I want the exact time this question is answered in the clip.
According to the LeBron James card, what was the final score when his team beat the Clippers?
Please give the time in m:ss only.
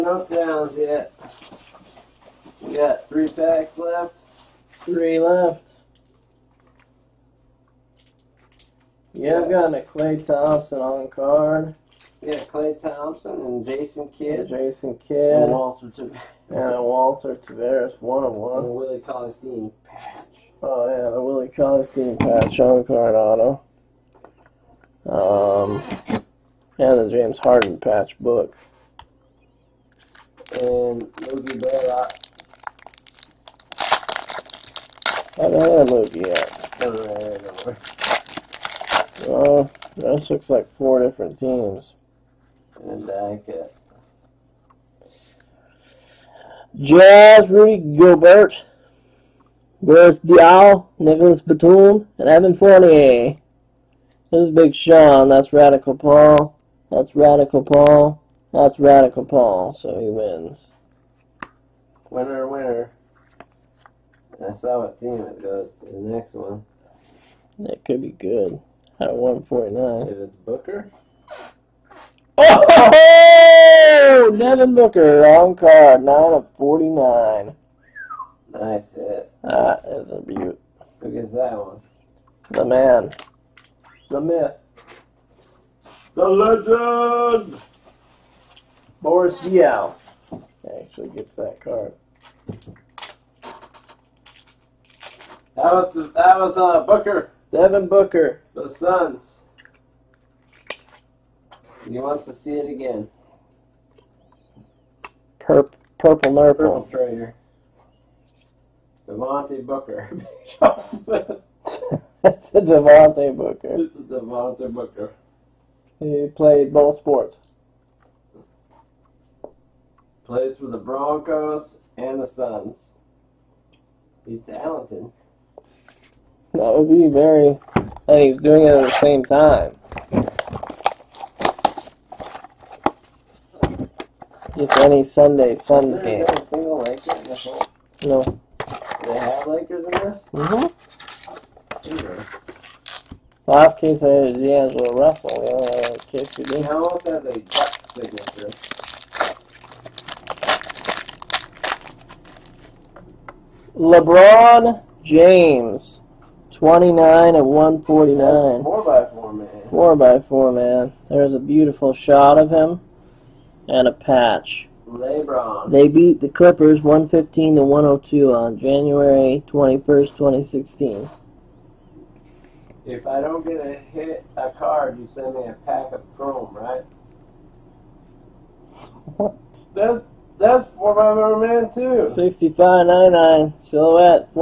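2:46.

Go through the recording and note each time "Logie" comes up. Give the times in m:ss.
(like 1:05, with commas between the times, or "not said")
0:31, 0:35.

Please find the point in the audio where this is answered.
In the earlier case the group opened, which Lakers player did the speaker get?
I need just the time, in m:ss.
2:24.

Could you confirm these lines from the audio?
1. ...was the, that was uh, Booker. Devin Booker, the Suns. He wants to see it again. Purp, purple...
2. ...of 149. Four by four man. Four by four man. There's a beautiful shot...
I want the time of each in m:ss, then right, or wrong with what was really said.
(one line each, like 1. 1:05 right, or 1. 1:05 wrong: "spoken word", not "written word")
1. 1:35 right
2. 2:37 right.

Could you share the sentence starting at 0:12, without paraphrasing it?
Yeah, Klay Thompson and Jason Kidd.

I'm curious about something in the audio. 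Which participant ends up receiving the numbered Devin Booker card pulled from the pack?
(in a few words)
Boris Yao.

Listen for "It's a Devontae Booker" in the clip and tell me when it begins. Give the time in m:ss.
1:53.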